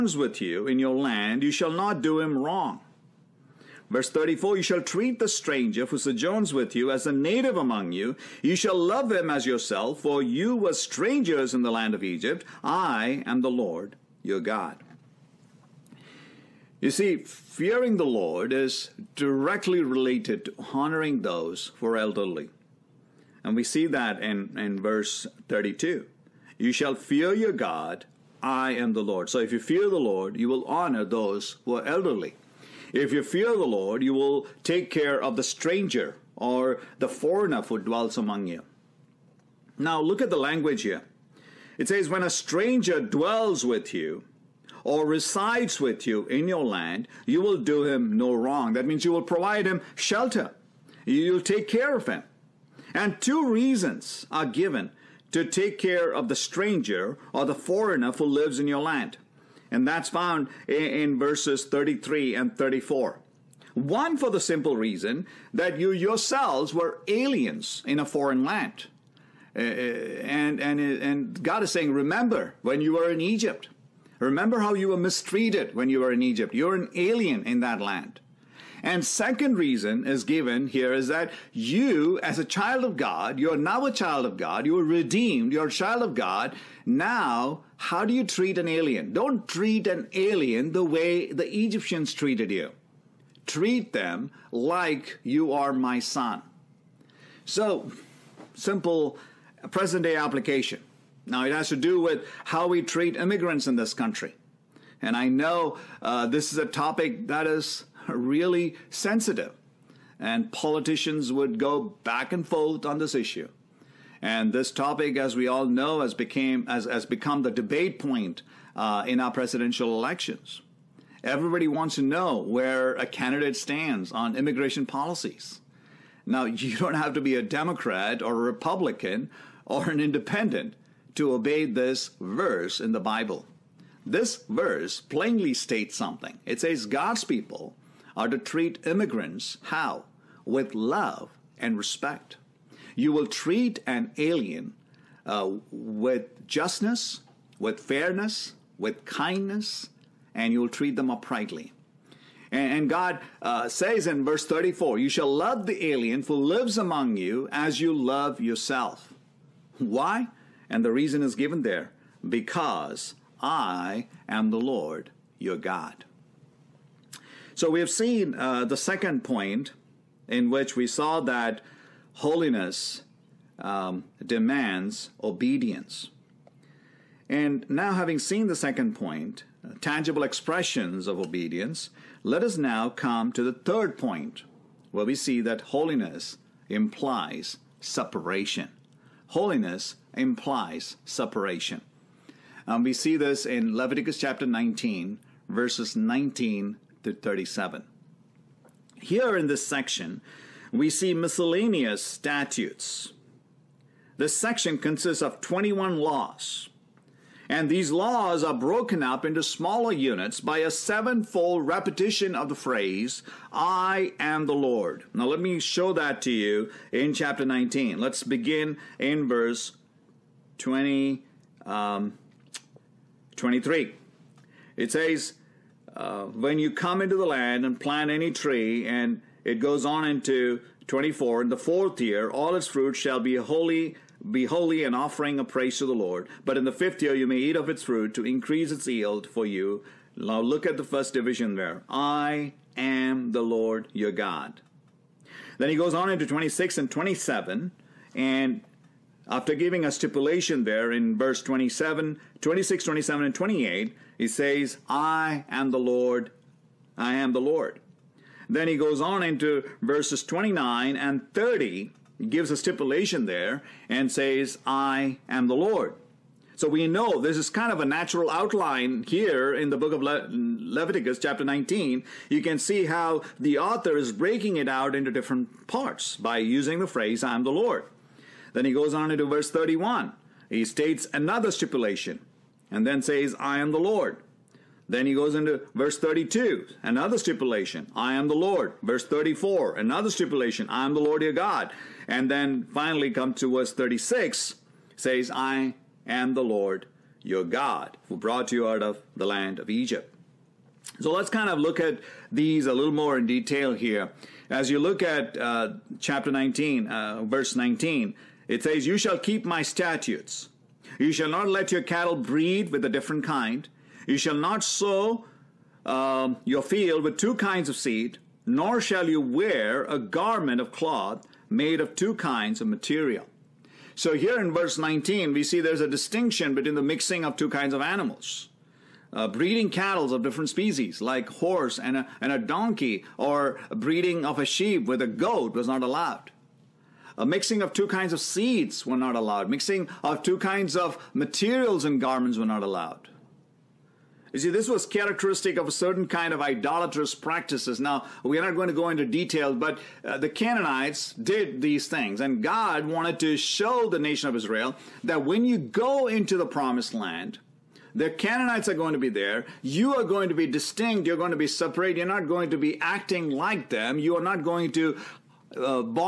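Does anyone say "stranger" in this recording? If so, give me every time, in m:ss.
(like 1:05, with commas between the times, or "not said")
0:05, 0:10, 0:35, 0:42, 0:56.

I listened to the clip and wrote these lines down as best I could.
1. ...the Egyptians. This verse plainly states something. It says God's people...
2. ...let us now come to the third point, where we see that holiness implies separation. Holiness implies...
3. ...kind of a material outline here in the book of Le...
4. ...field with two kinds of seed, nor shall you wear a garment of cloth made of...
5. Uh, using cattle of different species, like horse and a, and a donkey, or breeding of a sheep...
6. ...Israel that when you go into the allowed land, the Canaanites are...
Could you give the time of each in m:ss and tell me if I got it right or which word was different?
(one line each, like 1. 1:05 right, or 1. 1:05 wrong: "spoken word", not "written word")
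1. 2:12 wrong: "Bible", not "Egyptians"
2. 3:02 right
3. 4:27 wrong: "natural", not "material"
4. 5:16 right
5. 5:29 wrong: "breeding", not "using"
6. 5:54 wrong: "promised", not "allowed".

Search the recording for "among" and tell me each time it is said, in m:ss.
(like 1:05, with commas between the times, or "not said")
0:07, 0:38, 2:36.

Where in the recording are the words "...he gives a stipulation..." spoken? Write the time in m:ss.
4:22.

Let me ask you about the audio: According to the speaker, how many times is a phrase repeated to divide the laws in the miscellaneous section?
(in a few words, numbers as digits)
sevenfold.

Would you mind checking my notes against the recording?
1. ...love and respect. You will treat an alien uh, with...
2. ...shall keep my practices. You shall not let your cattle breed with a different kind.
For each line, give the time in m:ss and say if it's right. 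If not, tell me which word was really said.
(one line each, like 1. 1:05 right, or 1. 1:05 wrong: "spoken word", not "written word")
1. 2:20 right
2. 5:08 wrong: "statutes", not "practices".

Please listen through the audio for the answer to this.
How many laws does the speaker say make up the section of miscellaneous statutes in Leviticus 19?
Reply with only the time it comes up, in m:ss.
3:25.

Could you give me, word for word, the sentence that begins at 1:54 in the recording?
And this topic, as we all know, has became has, has become the debate point uh, in our presidential elections.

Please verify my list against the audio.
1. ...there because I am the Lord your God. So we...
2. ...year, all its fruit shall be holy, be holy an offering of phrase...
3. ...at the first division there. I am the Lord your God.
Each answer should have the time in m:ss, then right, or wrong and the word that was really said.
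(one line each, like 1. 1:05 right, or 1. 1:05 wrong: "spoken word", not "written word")
1. 2:41 right
2. 3:52 wrong: "praise", not "phrase"
3. 4:00 right.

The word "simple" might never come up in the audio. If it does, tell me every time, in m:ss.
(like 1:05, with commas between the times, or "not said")
1:04, 1:38.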